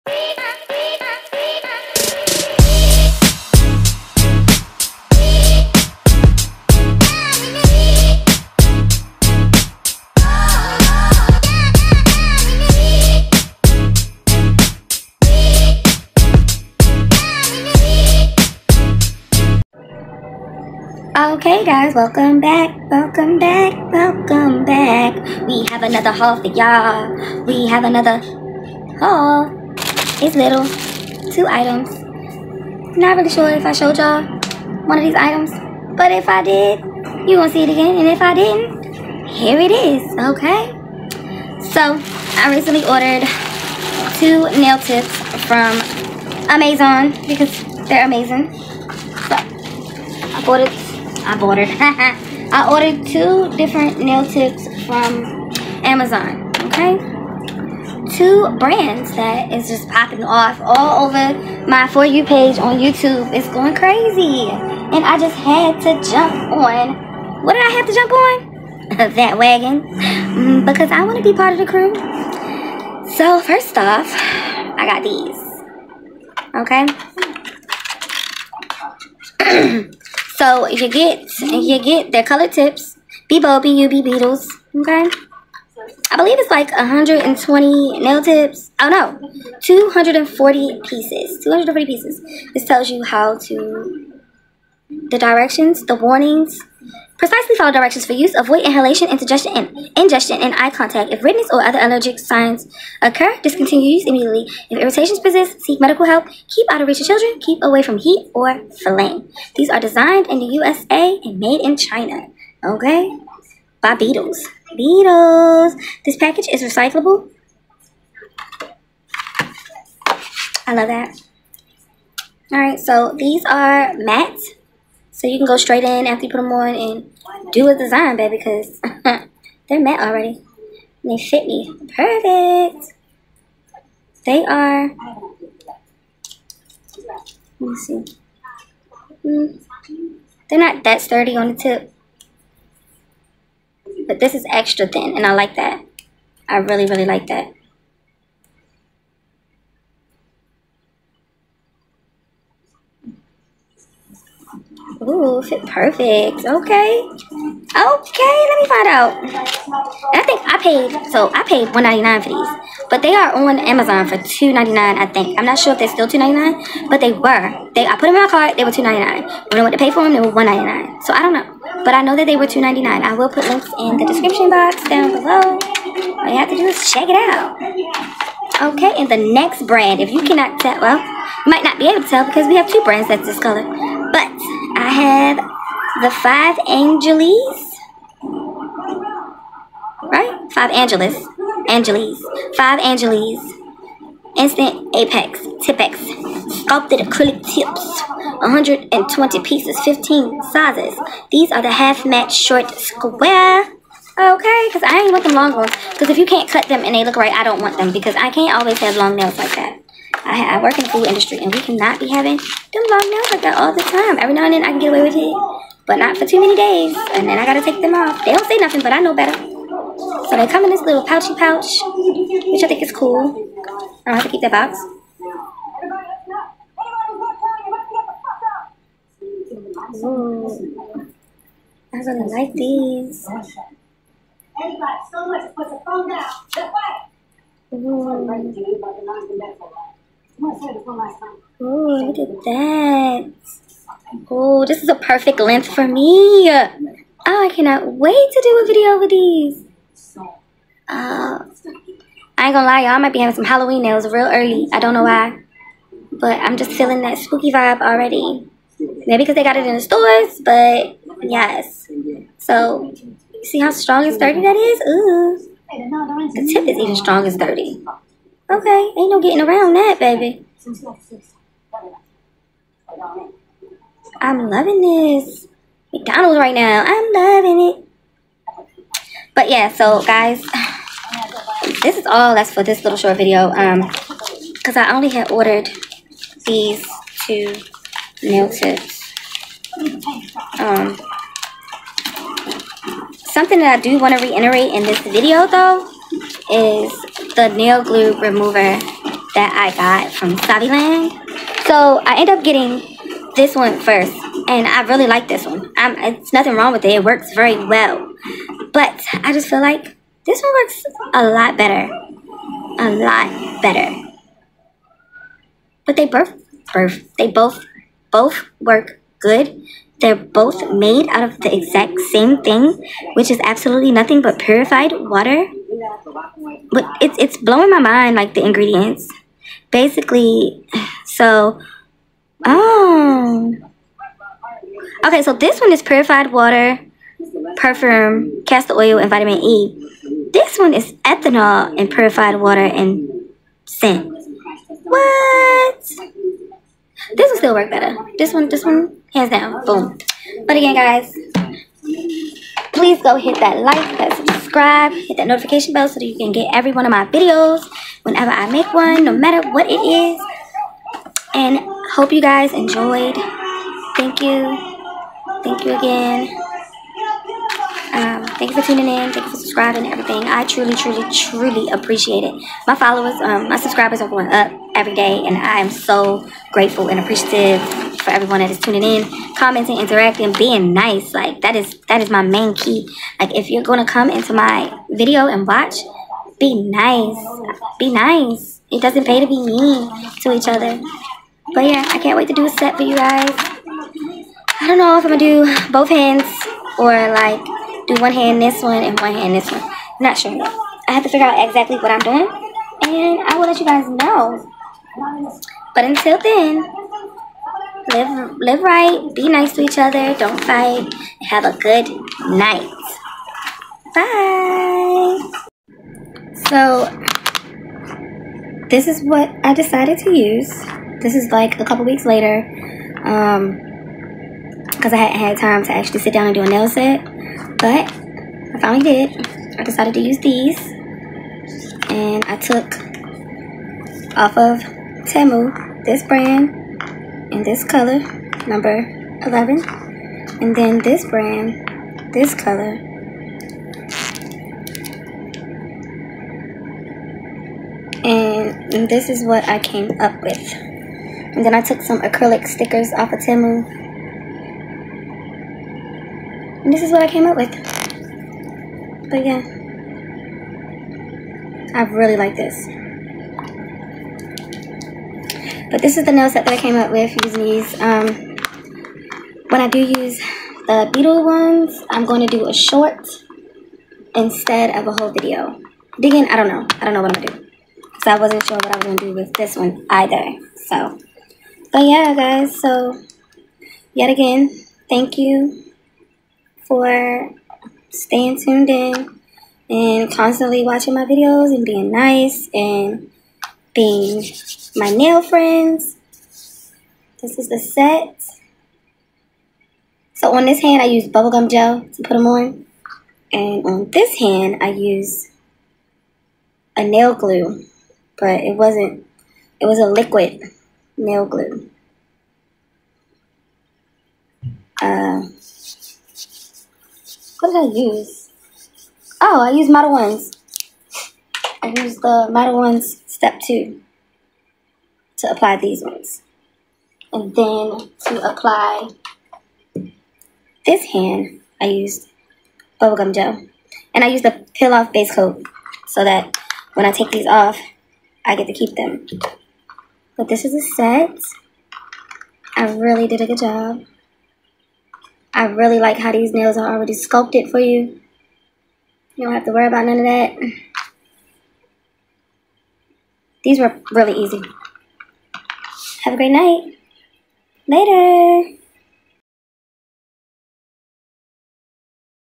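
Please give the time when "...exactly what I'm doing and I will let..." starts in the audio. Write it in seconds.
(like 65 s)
401 s.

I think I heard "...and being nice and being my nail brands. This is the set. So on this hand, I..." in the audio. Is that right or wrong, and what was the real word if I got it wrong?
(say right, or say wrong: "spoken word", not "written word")
wrong: "friends", not "brands".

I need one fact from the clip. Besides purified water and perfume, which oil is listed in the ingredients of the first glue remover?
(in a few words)
castor oil.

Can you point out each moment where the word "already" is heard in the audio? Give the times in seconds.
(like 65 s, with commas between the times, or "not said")
129 s, 257 s, 546 s.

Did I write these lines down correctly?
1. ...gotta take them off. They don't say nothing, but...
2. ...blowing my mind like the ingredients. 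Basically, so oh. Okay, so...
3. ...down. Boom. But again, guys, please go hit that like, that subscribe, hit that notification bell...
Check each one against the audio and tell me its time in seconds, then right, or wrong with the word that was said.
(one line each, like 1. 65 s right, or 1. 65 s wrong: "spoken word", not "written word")
1. 217 s right
2. 327 s right
3. 349 s right.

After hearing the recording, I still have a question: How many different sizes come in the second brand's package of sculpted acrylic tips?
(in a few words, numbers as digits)
15.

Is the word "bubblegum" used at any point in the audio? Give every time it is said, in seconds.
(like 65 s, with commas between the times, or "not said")
501 s, 532 s.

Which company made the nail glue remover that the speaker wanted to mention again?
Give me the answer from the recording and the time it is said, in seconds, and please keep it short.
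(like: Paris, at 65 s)
Saviland, at 300 s.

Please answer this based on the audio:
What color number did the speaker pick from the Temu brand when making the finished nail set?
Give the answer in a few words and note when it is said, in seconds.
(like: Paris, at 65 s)
11, at 438 s.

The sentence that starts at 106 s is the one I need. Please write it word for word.
Keep out of reach of children.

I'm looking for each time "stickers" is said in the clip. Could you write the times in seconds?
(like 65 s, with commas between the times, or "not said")
452 s.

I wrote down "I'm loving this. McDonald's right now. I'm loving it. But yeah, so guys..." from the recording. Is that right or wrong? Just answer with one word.
right.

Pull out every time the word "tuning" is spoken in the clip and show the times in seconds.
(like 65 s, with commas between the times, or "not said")
368 s, 378 s.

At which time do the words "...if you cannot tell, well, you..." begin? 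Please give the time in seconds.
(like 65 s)
179 s.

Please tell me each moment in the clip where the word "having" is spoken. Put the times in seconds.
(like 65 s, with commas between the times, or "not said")
212 s, 253 s.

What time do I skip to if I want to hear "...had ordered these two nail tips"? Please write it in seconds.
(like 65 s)
285 s.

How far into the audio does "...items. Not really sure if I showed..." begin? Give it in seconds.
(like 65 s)
31 s.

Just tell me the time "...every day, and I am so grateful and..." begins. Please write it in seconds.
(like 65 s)
374 s.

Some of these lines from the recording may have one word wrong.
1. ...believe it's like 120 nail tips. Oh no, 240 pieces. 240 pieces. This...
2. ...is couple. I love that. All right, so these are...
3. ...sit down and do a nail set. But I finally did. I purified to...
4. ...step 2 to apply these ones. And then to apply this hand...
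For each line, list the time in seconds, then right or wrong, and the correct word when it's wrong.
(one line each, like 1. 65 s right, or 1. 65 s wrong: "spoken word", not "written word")
1. 86 s right
2. 116 s wrong: "recyclable", not "couple"
3. 425 s wrong: "decided", not "purified"
4. 523 s right.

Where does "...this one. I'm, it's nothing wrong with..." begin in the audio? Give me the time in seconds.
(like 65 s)
305 s.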